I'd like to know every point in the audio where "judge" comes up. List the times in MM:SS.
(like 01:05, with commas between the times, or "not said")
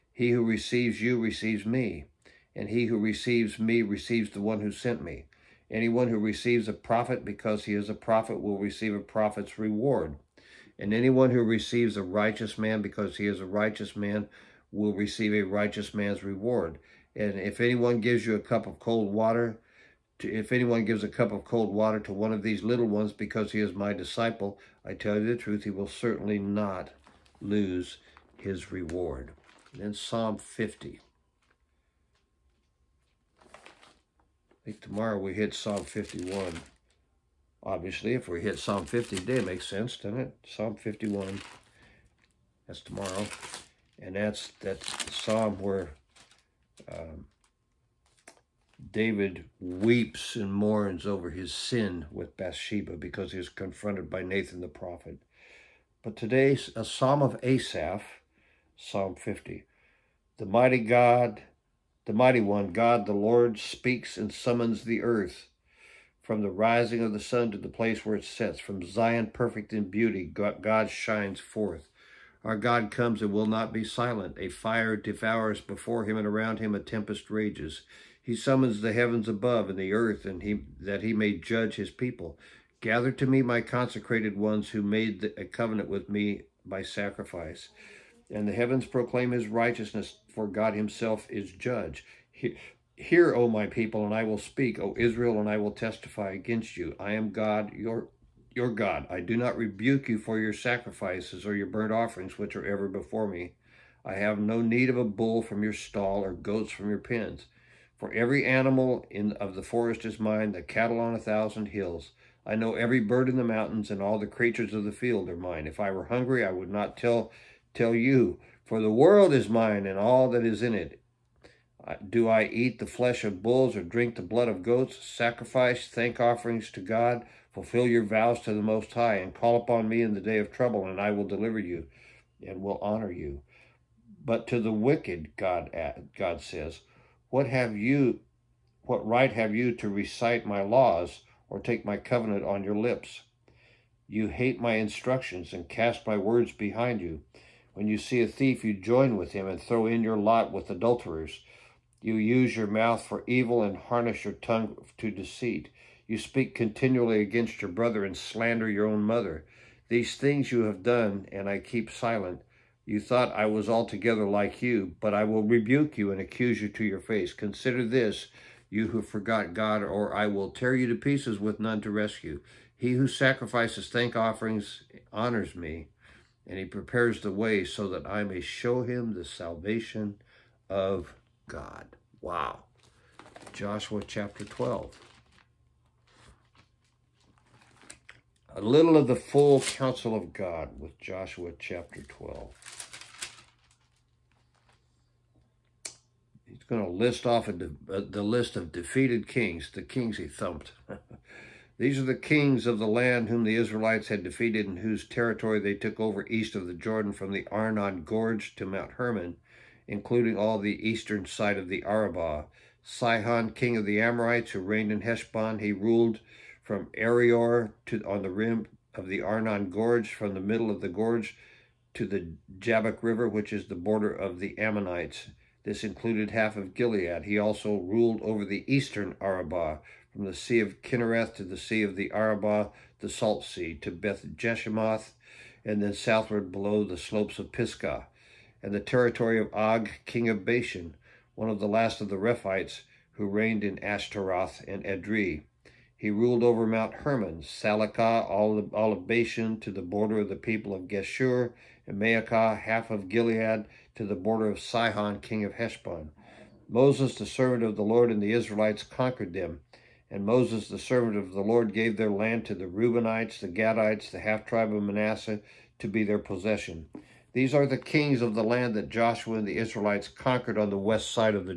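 01:21, 01:31.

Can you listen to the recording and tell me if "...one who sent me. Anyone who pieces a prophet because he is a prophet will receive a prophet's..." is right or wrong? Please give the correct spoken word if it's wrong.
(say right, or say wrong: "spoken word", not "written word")
wrong: "receives", not "pieces".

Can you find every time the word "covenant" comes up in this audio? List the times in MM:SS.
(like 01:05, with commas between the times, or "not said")
01:25, 02:21.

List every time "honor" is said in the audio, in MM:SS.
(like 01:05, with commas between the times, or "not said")
02:12, 02:55.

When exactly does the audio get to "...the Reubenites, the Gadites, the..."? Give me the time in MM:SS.
04:22.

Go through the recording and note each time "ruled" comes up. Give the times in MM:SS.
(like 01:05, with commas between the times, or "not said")
03:35, 03:47, 04:06.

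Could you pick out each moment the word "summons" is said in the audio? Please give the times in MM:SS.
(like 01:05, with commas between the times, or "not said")
01:04, 01:18.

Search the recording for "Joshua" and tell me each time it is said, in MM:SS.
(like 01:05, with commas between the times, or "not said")
03:03, 03:10, 04:28.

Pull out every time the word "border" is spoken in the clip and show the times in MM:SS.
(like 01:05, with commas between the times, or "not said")
03:43, 04:09, 04:14.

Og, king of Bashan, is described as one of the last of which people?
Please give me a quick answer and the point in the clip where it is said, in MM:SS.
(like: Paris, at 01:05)
Rephaites, at 04:02.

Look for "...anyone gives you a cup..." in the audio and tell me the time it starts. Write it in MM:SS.
00:17.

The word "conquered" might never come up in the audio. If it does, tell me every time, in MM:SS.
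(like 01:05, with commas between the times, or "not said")
04:18, 04:30.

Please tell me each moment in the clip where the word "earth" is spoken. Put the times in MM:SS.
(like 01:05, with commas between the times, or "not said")
01:05, 01:19.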